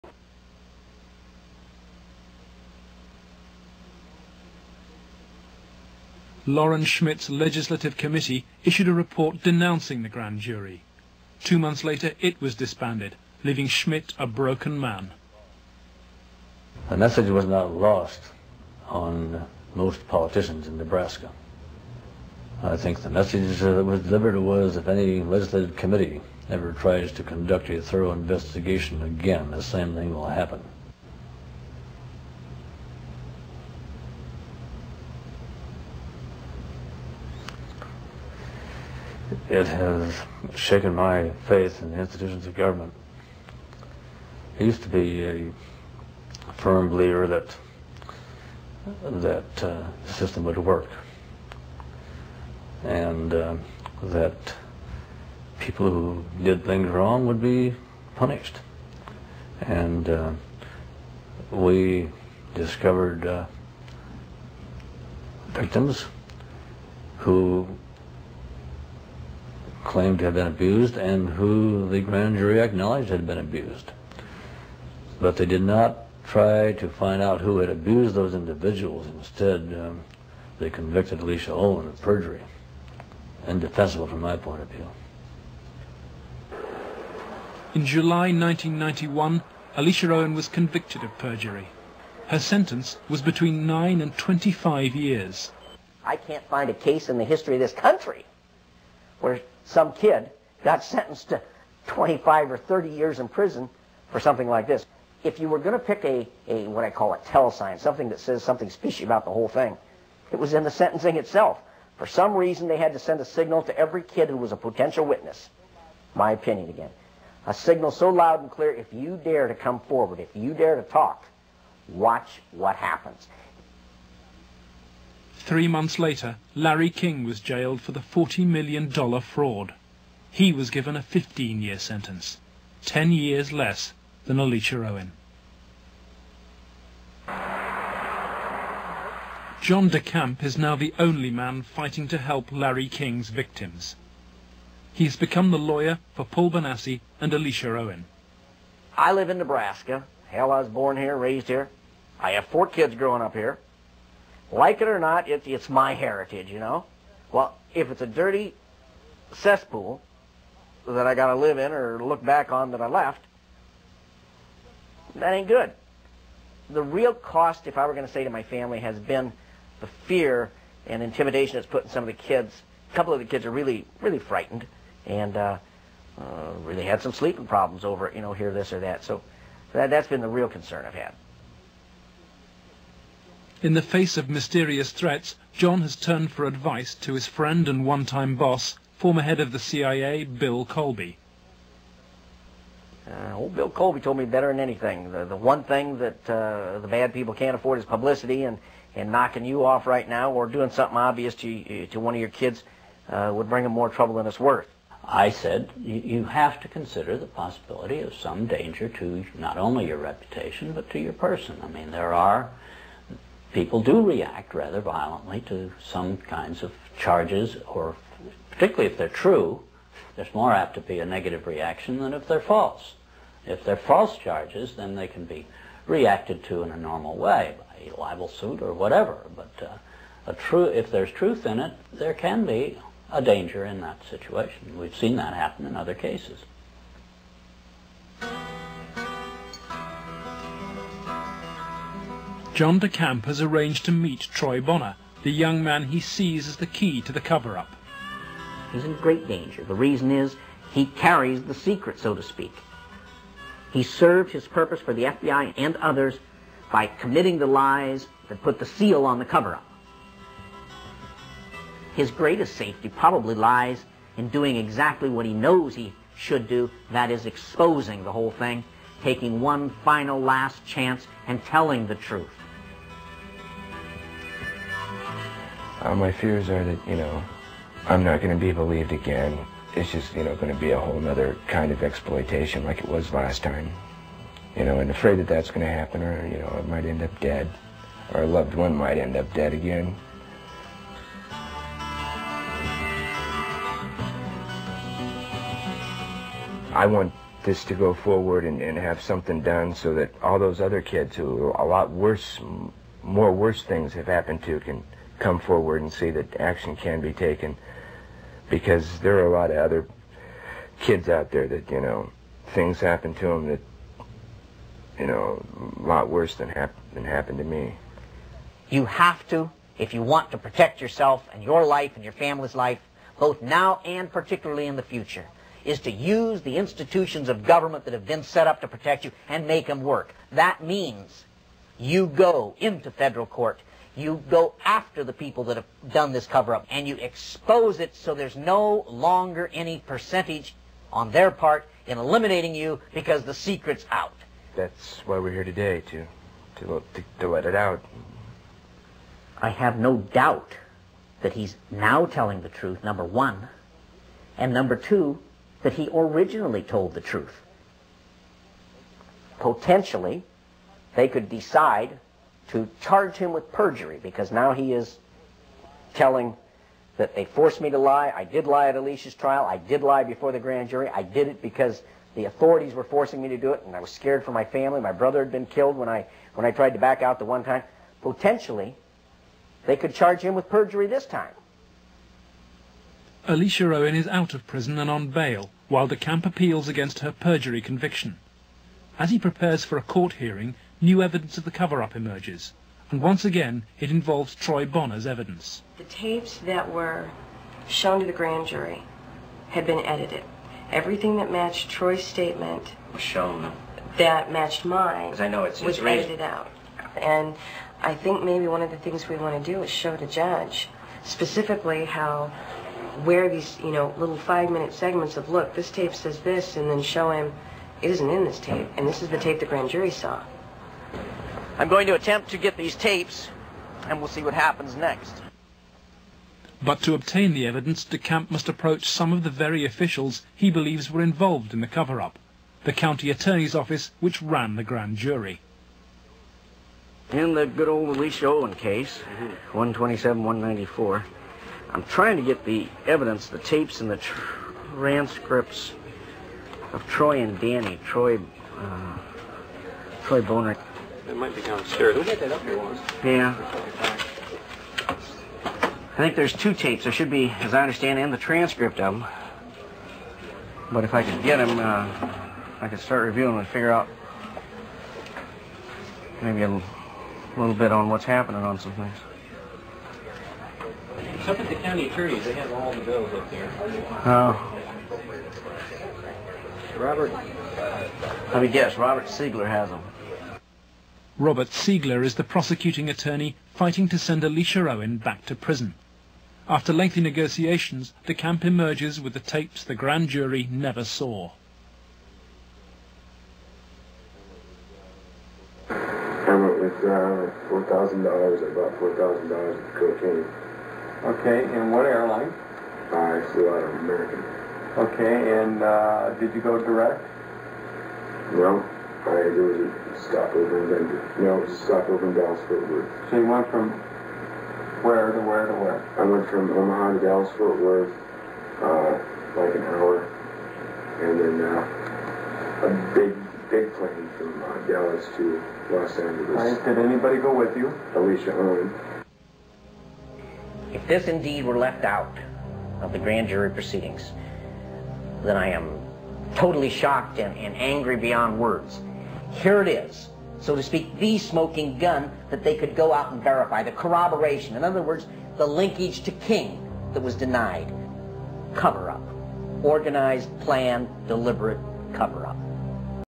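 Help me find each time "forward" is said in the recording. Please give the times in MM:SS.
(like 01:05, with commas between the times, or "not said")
01:59, 04:57, 05:05.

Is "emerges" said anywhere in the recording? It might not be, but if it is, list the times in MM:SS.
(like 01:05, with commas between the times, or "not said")
06:31, 08:08.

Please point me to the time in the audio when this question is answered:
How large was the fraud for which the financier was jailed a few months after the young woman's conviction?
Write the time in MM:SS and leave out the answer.
02:07.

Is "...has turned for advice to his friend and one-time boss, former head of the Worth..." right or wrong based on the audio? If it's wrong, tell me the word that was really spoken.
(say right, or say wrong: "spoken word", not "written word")
wrong: "CIA", not "Worth".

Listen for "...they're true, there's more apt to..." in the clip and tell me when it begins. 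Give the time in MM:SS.
03:38.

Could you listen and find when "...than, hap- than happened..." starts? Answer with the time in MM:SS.
05:16.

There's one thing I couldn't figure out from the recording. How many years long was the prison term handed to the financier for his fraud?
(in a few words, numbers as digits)
15 years.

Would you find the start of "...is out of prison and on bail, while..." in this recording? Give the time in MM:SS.
06:23.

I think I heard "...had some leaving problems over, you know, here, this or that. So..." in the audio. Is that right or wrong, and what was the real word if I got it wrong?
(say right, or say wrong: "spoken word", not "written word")
wrong: "sleeping", not "leaving".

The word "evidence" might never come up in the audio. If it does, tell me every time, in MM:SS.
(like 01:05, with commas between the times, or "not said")
06:31, 06:35, 07:07, 07:22.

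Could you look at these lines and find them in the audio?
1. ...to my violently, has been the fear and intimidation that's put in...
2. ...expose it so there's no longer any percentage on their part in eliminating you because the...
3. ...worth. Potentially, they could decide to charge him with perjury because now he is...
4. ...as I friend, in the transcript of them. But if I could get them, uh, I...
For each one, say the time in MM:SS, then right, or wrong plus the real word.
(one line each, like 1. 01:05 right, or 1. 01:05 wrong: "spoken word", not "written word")
1. 02:48 wrong: "family", not "violently"
2. 05:36 right
3. 05:57 wrong: "truth", not "worth"
4. 07:37 wrong: "understand", not "friend".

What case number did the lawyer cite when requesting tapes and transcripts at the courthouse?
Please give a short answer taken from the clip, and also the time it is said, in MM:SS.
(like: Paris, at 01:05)
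127-194, at 07:19.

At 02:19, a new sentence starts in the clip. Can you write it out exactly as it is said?
John DeCamp is now the only man fighting to help Larry King's victims.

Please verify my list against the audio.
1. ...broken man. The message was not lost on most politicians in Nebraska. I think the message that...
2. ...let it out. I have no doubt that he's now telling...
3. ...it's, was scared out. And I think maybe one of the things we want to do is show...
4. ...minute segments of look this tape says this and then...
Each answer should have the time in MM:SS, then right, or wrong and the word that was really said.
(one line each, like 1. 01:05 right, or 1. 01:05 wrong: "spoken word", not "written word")
1. 00:14 right
2. 05:47 right
3. 06:45 wrong: "edited", not "scared"
4. 06:54 right.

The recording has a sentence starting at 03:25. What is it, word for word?
I said, you have to consider the possibility of some danger to not only your reputation, but to your person.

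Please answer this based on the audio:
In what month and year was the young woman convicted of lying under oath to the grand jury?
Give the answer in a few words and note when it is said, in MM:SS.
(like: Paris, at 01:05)
July 1991, at 01:27.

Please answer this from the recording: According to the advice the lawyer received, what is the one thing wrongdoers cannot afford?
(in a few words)
Publicity.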